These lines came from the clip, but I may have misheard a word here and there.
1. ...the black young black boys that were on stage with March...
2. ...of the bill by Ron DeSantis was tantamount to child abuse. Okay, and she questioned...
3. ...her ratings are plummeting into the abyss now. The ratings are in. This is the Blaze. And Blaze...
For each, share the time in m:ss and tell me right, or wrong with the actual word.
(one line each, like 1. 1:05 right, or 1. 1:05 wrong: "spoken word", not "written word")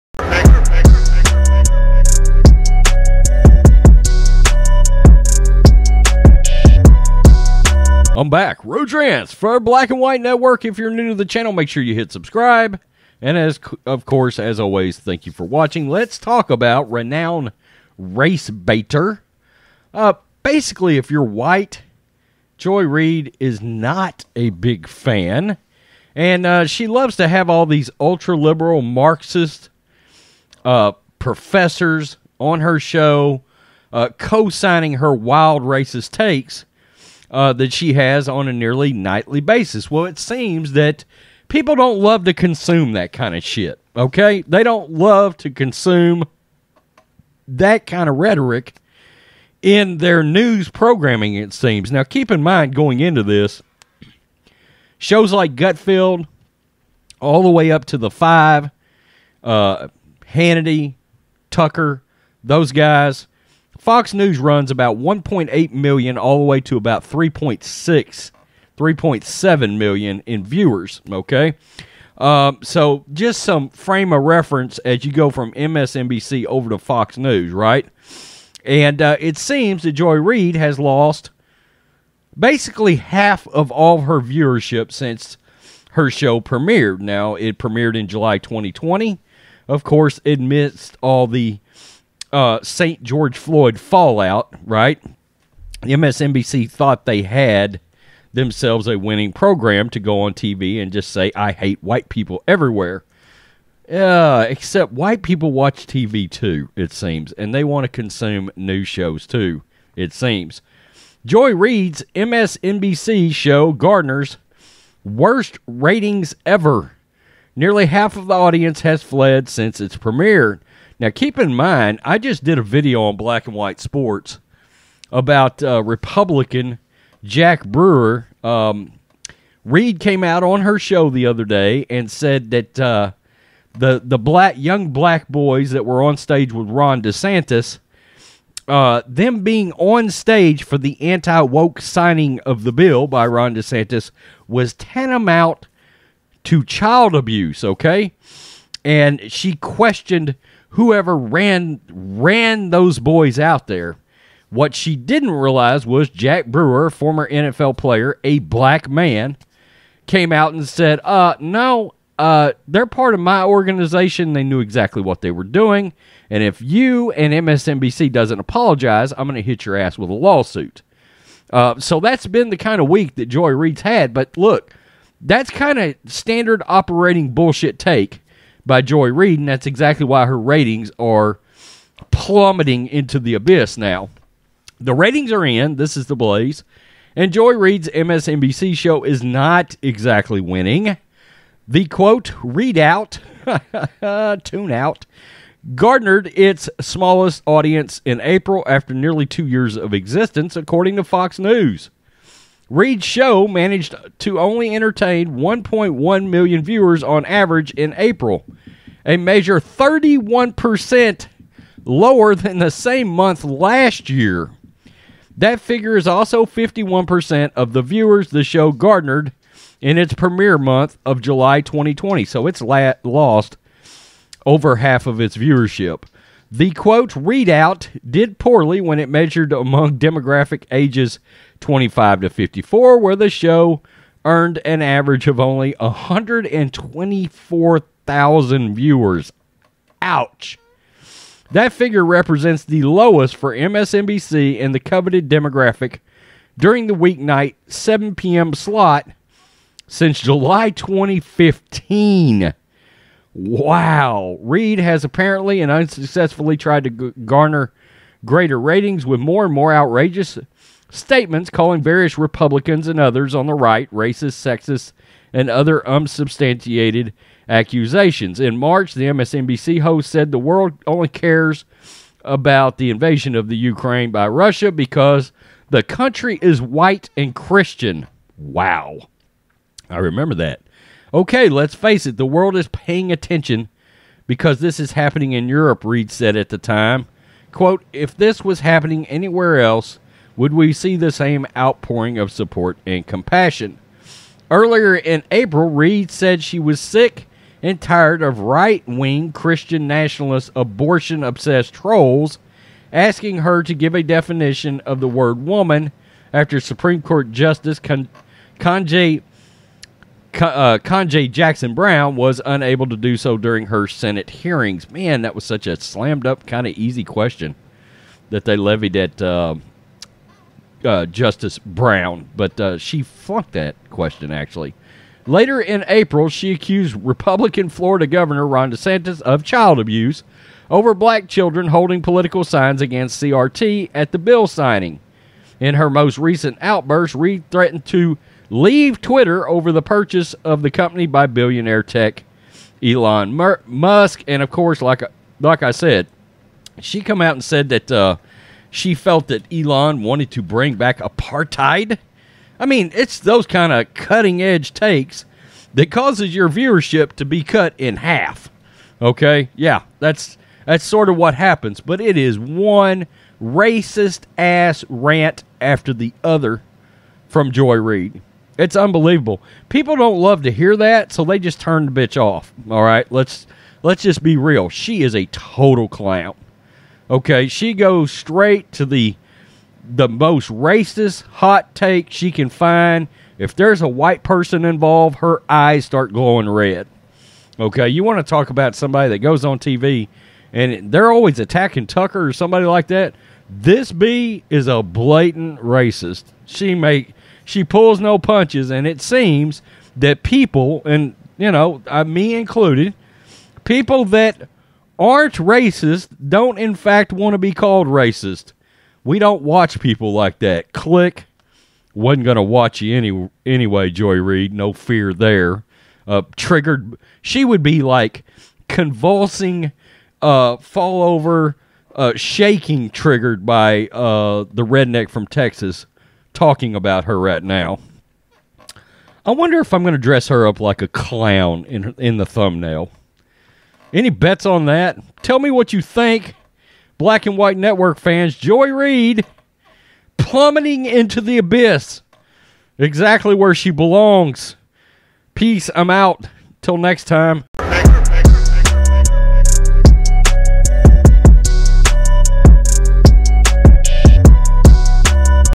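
1. 2:14 wrong: "Ron", not "March"
2. 2:22 right
3. 3:00 wrong: "Joy", not "Blaze".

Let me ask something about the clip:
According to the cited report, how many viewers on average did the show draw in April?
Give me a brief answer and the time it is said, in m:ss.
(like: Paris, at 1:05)
1.1 million, at 3:25.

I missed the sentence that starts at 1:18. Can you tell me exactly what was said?
And uh, it seems that Joy Reid has lost basically half of all her viewership since her show premiered.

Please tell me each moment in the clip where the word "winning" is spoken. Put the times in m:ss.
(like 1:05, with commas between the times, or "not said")
1:38, 3:10.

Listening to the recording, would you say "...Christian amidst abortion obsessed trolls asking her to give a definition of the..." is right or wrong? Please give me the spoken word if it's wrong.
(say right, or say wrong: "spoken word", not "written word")
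wrong: "nationalist", not "amidst".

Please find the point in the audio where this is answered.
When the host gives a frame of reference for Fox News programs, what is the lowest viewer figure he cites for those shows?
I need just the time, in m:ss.
1:04.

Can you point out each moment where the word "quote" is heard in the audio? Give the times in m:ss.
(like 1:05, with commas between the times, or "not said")
3:11, 3:46, 4:47.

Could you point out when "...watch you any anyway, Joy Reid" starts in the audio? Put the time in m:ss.
6:52.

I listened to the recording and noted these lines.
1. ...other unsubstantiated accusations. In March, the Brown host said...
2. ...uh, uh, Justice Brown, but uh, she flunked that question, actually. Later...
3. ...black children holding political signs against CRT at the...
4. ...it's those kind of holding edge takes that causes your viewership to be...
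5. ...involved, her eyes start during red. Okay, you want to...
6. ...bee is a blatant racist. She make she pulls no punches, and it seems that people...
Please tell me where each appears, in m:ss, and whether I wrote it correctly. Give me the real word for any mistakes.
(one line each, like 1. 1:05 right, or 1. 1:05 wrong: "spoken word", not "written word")
1. 4:25 wrong: "MSNBC", not "Brown"
2. 5:19 right
3. 5:30 right
4. 5:52 wrong: "cutting", not "holding"
5. 6:24 wrong: "glowing", not "during"
6. 6:33 right.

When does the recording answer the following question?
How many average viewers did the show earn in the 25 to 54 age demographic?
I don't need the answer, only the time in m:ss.
3:55.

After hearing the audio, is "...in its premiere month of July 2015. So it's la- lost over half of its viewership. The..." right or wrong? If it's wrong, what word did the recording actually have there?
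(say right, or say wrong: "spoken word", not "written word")
wrong: "2020", not "2015".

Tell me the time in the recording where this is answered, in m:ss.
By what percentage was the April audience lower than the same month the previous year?
3:29.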